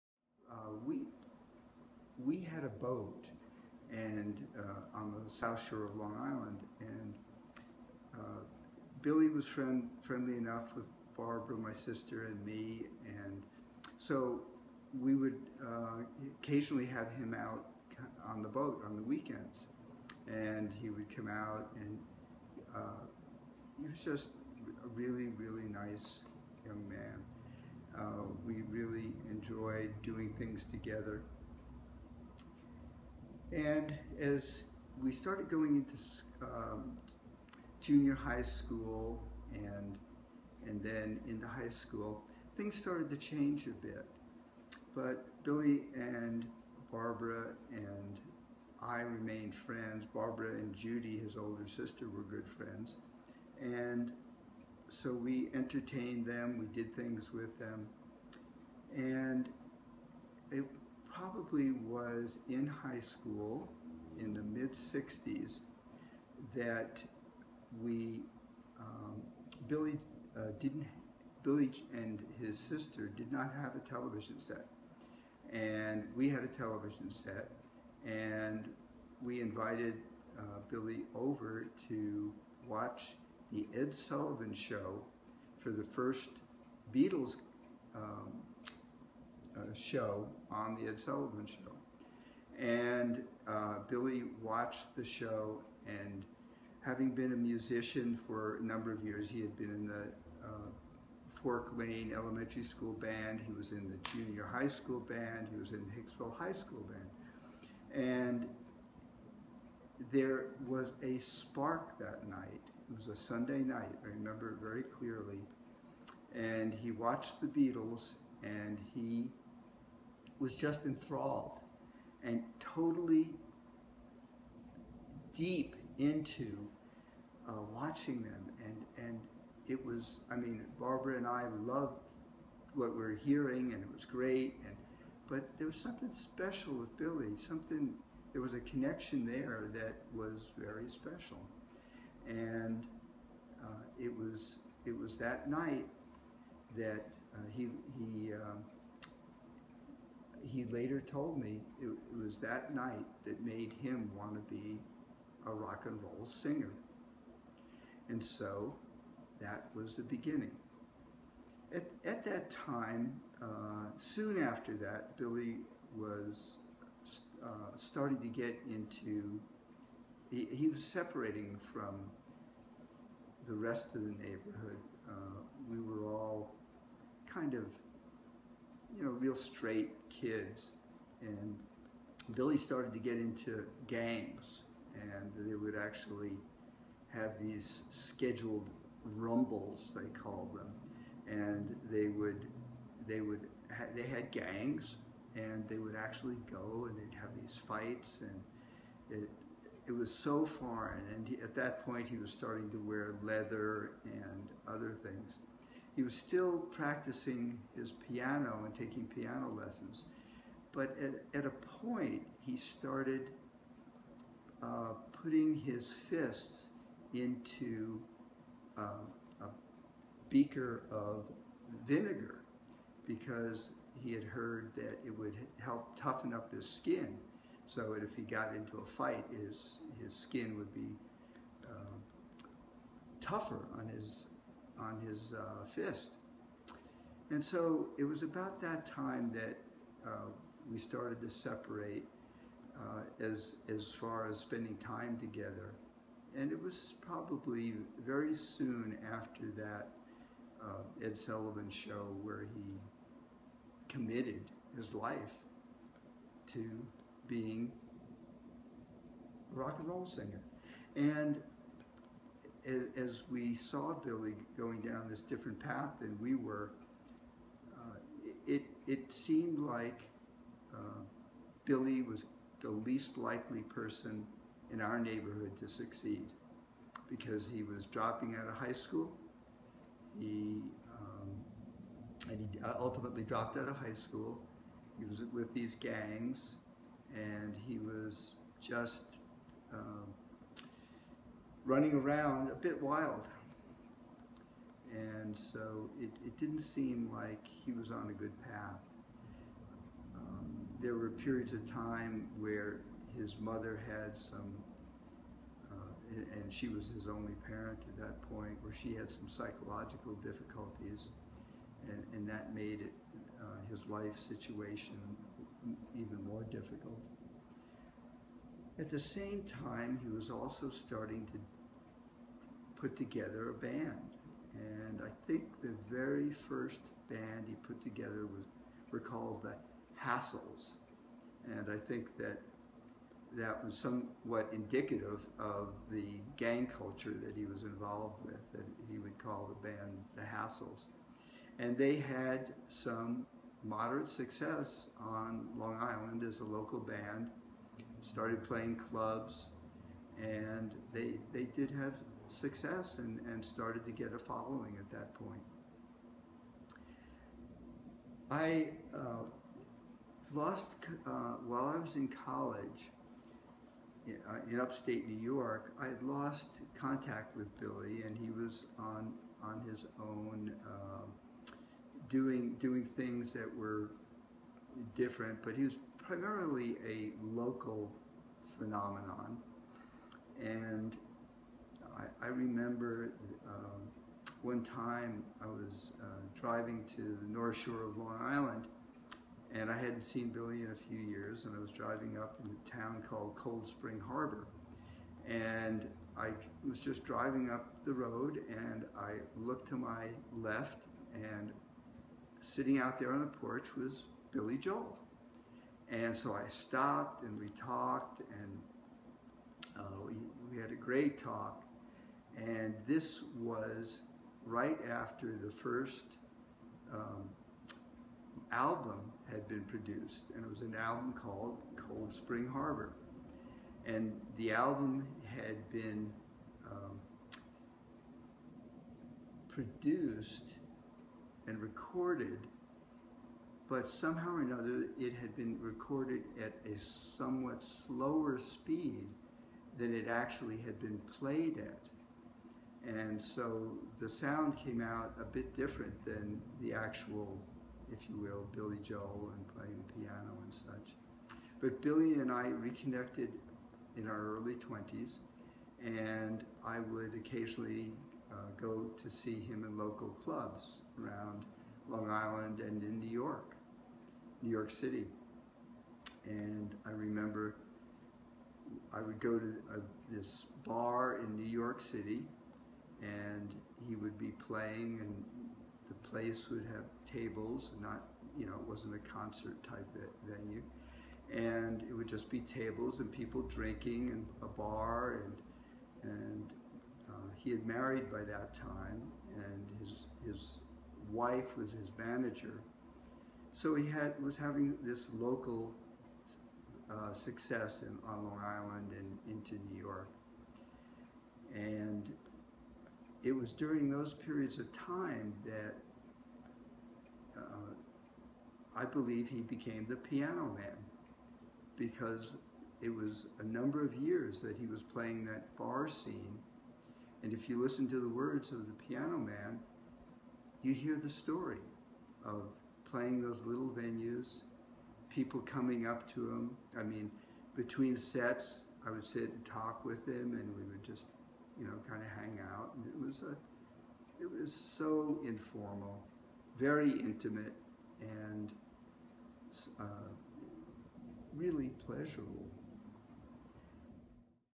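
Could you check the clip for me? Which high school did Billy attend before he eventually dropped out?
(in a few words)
Hicksville High School.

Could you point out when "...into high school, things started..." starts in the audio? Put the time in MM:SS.
00:41.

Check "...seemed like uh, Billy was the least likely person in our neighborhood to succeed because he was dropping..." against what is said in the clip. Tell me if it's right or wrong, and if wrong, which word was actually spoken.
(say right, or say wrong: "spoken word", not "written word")
right.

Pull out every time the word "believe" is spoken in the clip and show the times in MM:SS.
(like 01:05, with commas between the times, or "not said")
08:28.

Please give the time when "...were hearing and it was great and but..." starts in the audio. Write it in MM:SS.
02:12.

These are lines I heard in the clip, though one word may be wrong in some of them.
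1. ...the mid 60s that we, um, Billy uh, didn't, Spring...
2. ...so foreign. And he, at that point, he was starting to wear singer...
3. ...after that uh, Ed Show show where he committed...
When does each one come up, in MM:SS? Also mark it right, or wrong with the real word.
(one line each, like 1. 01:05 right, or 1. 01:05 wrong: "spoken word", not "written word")
1. 01:04 wrong: "Billy", not "Spring"
2. 03:20 wrong: "leather", not "singer"
3. 04:09 wrong: "Sullivan", not "Show".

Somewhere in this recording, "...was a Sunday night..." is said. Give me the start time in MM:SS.
01:52.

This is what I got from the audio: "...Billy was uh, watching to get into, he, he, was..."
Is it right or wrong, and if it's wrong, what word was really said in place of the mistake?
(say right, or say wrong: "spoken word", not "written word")
wrong: "starting", not "watching".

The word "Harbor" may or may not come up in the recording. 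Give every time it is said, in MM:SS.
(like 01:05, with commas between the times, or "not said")
06:33, 07:02.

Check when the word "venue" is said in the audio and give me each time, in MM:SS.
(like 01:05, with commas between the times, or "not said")
08:00, 08:43.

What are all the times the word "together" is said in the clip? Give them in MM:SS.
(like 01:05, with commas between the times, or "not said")
00:30, 04:05, 05:22, 05:27.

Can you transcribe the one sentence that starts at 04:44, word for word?
He was with these gangs and he was just um, running around a bit wild.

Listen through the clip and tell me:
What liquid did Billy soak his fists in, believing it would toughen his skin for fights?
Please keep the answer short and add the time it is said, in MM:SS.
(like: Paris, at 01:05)
Vinegar, at 03:41.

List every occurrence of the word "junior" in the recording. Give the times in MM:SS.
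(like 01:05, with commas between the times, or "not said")
00:37, 01:44.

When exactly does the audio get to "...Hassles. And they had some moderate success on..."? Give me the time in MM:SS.
05:40.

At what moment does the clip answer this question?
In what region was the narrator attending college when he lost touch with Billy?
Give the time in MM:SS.
06:04.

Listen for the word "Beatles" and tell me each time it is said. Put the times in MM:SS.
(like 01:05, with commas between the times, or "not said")
01:26, 01:57.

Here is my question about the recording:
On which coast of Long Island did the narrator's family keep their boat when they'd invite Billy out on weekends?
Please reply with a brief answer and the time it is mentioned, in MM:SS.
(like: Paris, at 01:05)
South shore, at 00:05.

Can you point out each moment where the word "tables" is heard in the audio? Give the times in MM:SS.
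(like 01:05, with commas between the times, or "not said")
07:57, 08:02.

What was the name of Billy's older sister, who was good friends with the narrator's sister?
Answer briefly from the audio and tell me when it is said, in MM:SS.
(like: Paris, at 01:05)
Judy, at 00:50.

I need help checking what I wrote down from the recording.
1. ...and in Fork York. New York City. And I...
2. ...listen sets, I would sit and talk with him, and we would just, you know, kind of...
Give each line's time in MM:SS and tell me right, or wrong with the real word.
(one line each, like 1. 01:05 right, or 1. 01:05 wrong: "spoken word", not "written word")
1. 07:42 wrong: "New", not "Fork"
2. 08:47 wrong: "between", not "listen".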